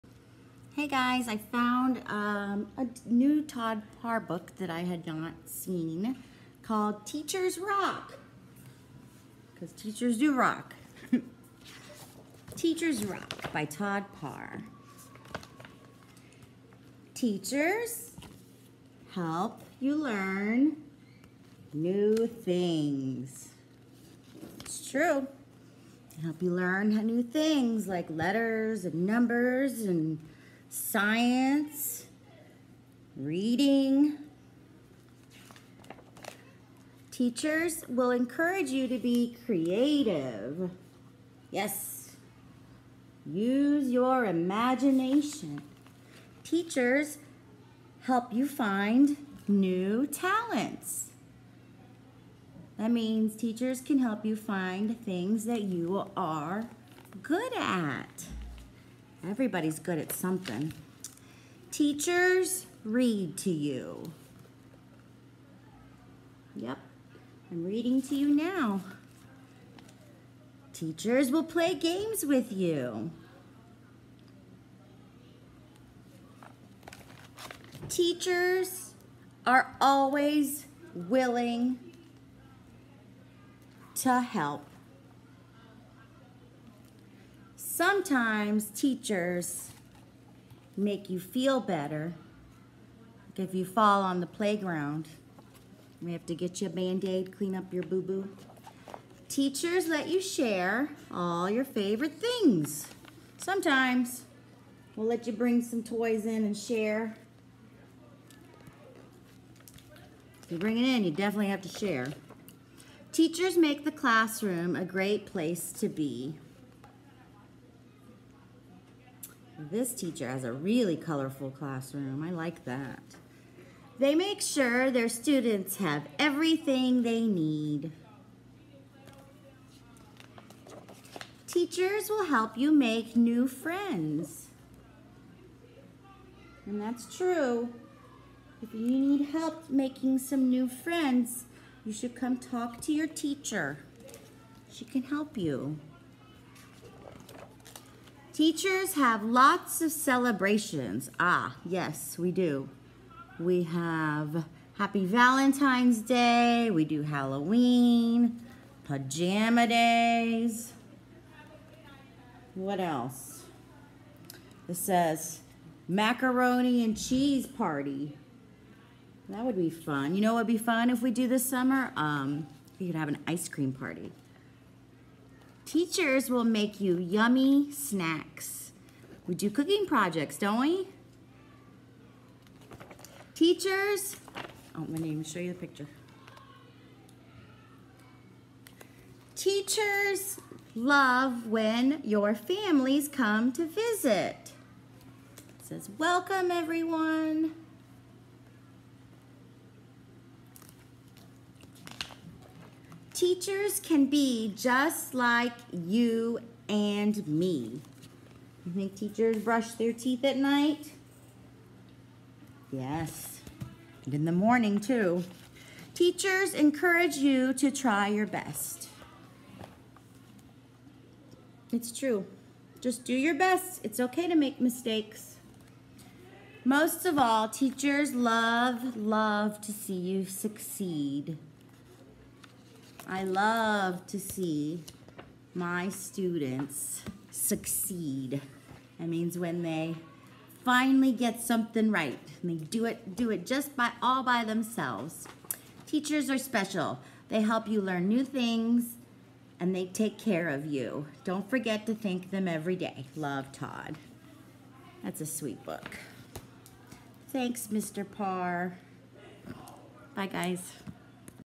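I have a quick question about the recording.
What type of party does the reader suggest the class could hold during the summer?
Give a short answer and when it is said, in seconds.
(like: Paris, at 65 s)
Ice cream party, at 173 s.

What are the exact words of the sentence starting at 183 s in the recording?
Teachers, oh, I'm gonna even show you the picture.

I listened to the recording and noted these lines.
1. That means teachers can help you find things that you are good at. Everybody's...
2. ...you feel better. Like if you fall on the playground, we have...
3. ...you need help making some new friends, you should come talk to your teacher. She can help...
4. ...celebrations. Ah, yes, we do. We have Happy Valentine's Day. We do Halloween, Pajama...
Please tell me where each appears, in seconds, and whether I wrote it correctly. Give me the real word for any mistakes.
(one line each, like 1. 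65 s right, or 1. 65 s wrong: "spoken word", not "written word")
1. 52 s right
2. 91 s right
3. 138 s right
4. 149 s right.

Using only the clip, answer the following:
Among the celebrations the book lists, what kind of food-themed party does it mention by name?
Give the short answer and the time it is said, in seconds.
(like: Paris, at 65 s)
Macaroni and cheese party, at 165 s.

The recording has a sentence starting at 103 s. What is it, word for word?
Sometimes we'll let you bring some toys in and share.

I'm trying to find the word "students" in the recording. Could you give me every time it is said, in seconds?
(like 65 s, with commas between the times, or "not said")
125 s, 235 s.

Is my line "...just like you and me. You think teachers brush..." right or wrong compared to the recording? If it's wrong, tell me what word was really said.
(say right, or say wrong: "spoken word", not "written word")
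right.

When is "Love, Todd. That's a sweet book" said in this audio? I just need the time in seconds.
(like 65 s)
253 s.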